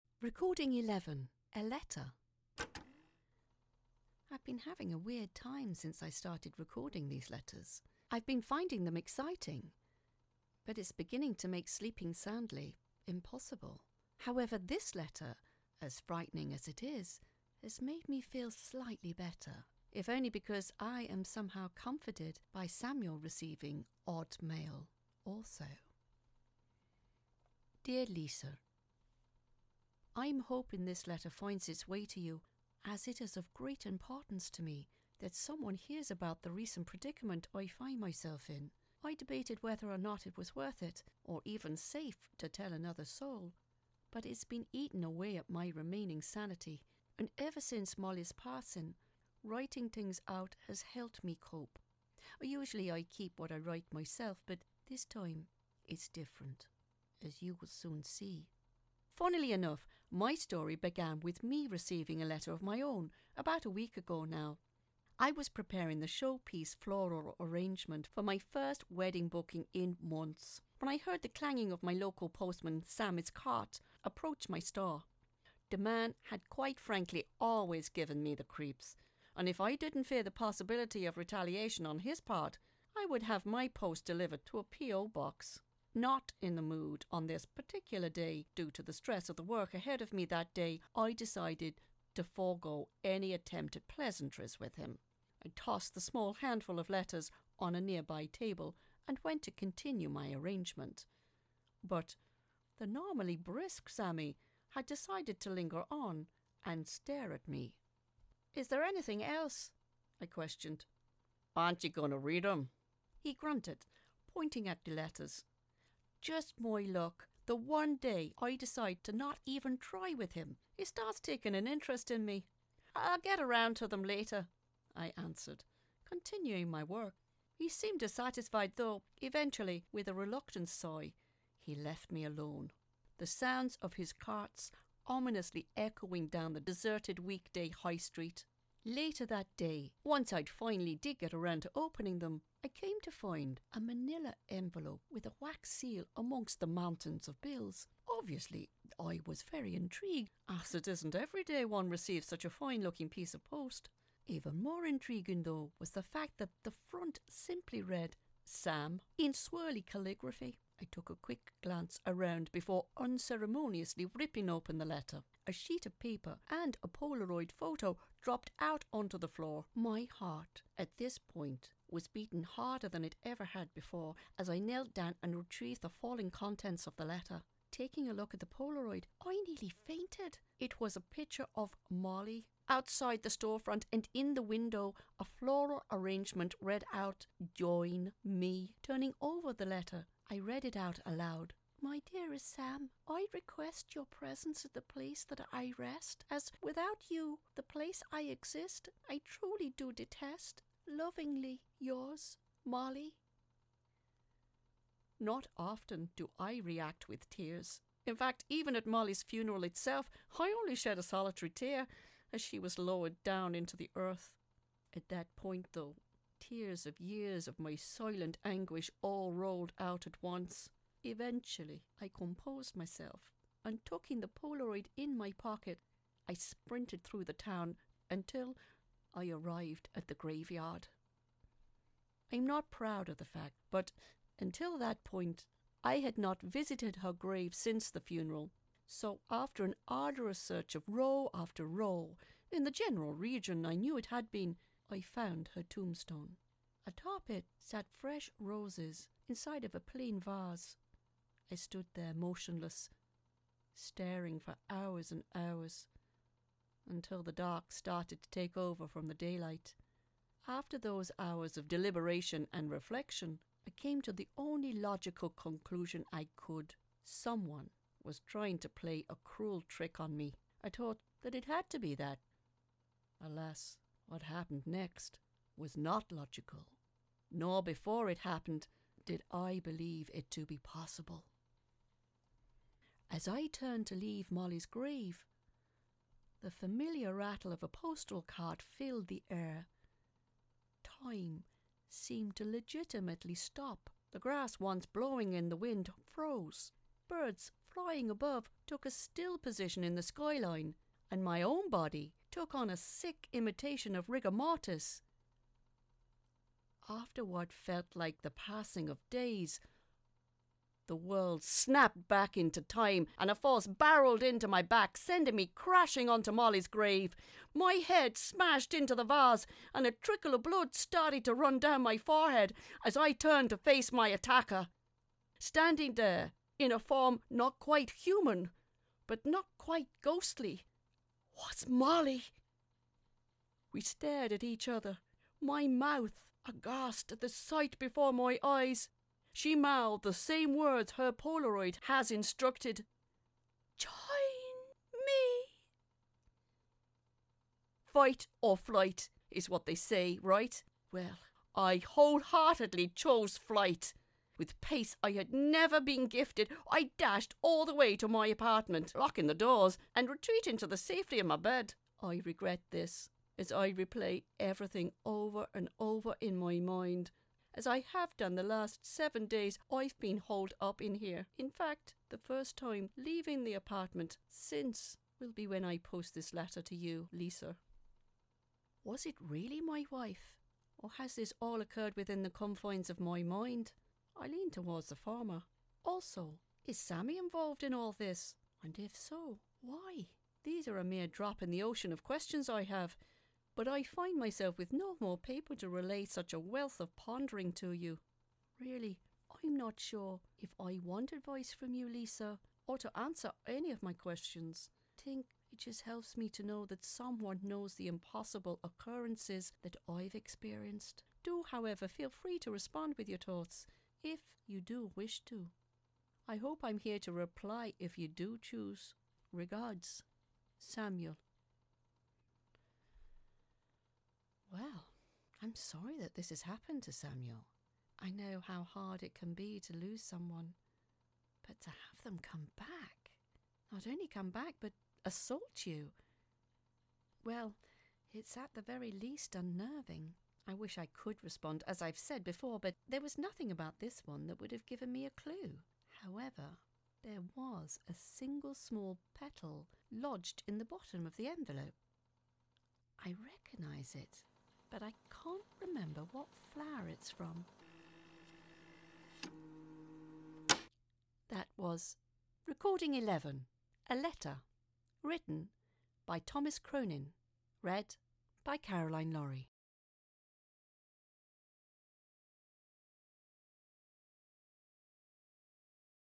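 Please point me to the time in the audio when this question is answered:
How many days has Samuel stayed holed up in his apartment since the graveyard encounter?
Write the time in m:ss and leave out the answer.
6:08.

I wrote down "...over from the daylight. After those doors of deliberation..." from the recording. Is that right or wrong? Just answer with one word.
wrong.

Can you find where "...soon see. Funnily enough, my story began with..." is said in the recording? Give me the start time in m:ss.
0:57.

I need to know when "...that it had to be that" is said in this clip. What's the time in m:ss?
4:31.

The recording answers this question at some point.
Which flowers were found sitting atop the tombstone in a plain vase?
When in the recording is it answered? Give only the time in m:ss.
4:08.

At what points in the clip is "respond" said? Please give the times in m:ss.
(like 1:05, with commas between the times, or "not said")
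6:52, 7:21.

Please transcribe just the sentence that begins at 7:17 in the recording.
Well, it's at the very least unnerving.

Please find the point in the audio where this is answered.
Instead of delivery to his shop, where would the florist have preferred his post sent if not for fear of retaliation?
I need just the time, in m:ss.
1:24.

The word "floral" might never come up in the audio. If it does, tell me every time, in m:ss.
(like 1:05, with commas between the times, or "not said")
1:06, 3:05.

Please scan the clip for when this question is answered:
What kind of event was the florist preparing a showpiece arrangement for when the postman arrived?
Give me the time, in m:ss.
1:08.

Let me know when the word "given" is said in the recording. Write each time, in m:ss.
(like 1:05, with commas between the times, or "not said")
1:17, 7:24.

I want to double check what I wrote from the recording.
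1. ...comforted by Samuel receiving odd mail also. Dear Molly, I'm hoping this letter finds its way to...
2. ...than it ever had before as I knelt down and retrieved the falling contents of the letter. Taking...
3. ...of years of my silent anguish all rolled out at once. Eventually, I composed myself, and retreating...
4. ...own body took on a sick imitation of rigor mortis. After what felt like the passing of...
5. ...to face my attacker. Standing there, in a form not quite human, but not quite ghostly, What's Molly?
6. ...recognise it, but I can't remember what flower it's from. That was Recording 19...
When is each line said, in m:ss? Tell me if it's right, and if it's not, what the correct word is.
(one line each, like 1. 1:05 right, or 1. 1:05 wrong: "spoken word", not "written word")
1. 0:21 wrong: "Lisa", not "Molly"
2. 2:52 right
3. 3:36 wrong: "tucking", not "retreating"
4. 5:01 right
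5. 5:23 right
6. 7:33 wrong: "11", not "19".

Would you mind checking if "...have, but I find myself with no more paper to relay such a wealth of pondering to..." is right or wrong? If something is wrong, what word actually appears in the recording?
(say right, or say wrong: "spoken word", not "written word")
right.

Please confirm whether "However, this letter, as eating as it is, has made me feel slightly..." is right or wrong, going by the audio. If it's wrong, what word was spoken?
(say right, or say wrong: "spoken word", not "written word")
wrong: "frightening", not "eating".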